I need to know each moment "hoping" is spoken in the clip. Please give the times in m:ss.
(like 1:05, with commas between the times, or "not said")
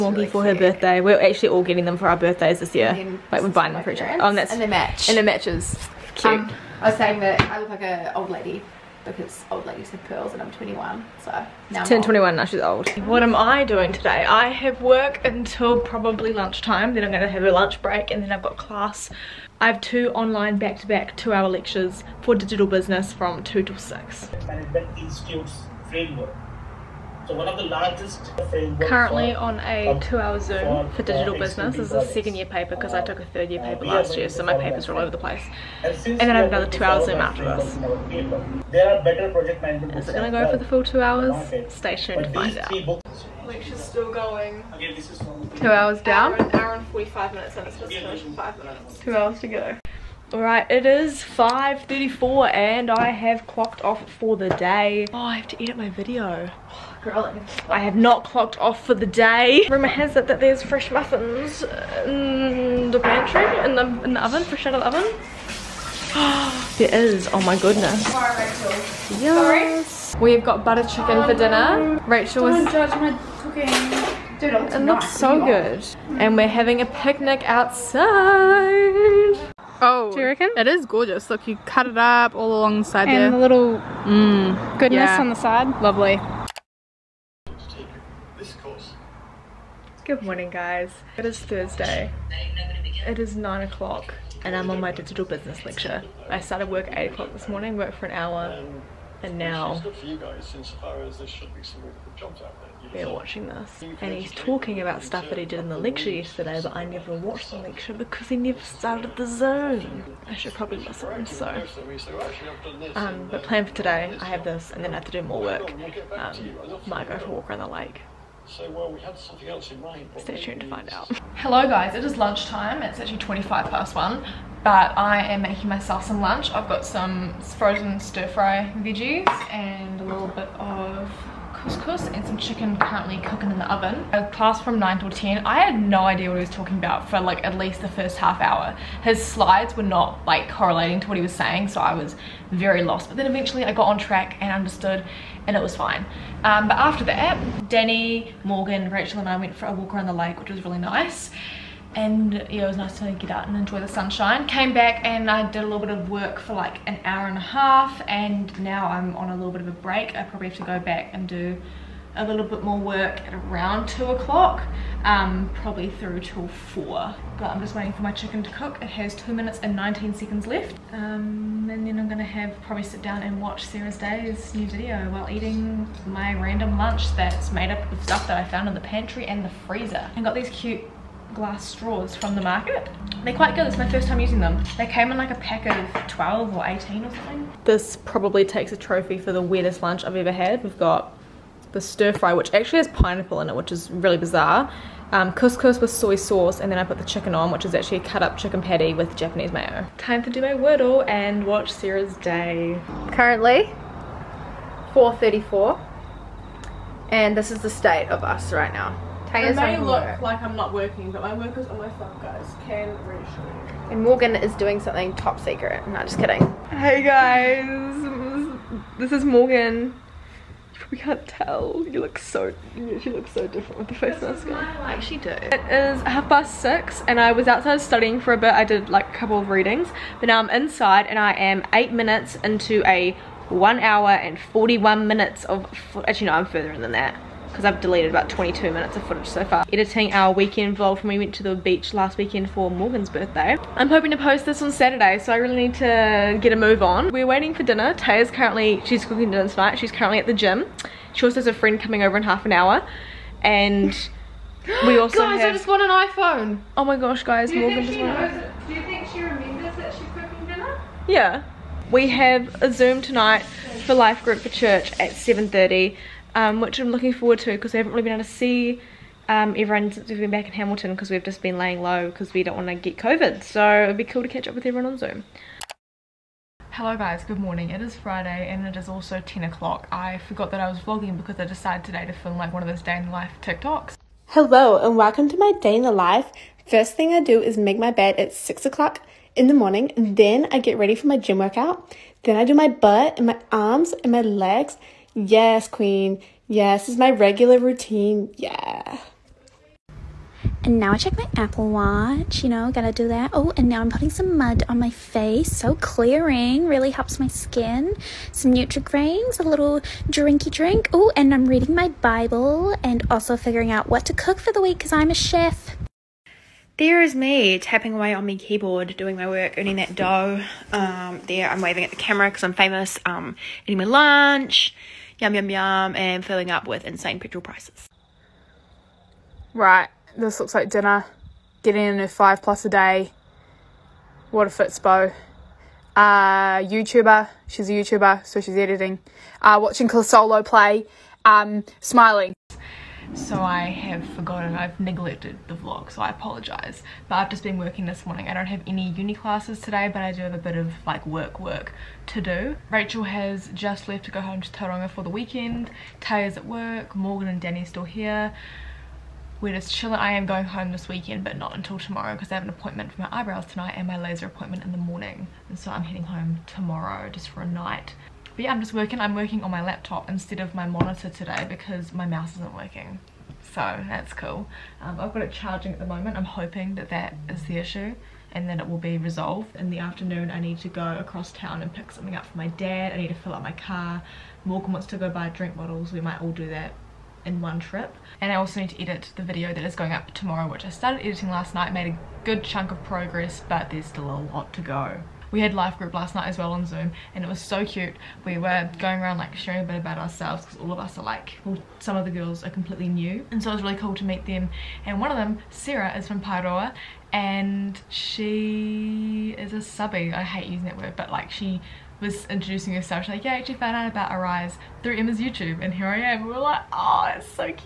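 4:03, 6:16.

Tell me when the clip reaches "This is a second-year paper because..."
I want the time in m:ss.
0:31.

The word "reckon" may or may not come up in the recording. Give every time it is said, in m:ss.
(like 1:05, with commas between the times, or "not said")
1:20.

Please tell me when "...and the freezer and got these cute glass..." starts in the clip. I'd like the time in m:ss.
2:59.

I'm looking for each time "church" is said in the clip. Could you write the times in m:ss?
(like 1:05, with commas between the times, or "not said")
4:24.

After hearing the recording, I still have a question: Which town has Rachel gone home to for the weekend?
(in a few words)
Tauranga.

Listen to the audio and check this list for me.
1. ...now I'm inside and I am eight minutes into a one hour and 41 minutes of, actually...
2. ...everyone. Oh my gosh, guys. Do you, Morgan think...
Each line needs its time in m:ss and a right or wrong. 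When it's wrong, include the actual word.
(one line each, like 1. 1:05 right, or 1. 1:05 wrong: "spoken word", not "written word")
1. 3:50 right
2. 4:15 wrong: "iPhone", not "everyone".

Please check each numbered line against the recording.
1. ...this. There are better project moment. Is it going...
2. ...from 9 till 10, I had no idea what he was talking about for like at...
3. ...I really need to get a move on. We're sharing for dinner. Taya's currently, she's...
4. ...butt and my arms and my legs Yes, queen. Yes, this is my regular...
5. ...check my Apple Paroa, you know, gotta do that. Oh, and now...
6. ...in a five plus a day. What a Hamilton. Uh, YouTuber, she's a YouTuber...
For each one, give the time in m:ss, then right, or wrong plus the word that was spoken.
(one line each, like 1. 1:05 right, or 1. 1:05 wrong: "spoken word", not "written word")
1. 0:37 wrong: "management", not "moment"
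2. 2:14 right
3. 4:05 wrong: "waiting", not "sharing"
4. 4:52 right
5. 5:00 wrong: "Watch", not "Paroa"
6. 5:31 wrong: "Fitzbo", not "Hamilton".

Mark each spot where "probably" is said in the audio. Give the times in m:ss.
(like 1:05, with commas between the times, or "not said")
0:15, 1:50, 2:40, 2:45, 2:52, 3:07.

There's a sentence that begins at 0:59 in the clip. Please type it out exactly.
Rumour has it that there's fresh muffins in the pantry, in the, in the oven, fresh out of the oven.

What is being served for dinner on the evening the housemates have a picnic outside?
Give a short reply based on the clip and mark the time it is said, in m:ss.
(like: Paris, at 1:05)
Butter chicken, at 1:10.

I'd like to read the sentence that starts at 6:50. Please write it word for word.
I hate using that word, but like she was introducing herself.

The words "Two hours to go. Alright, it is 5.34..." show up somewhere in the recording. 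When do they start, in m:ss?
0:48.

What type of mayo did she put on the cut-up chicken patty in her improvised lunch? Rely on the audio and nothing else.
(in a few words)
Japanese mayo.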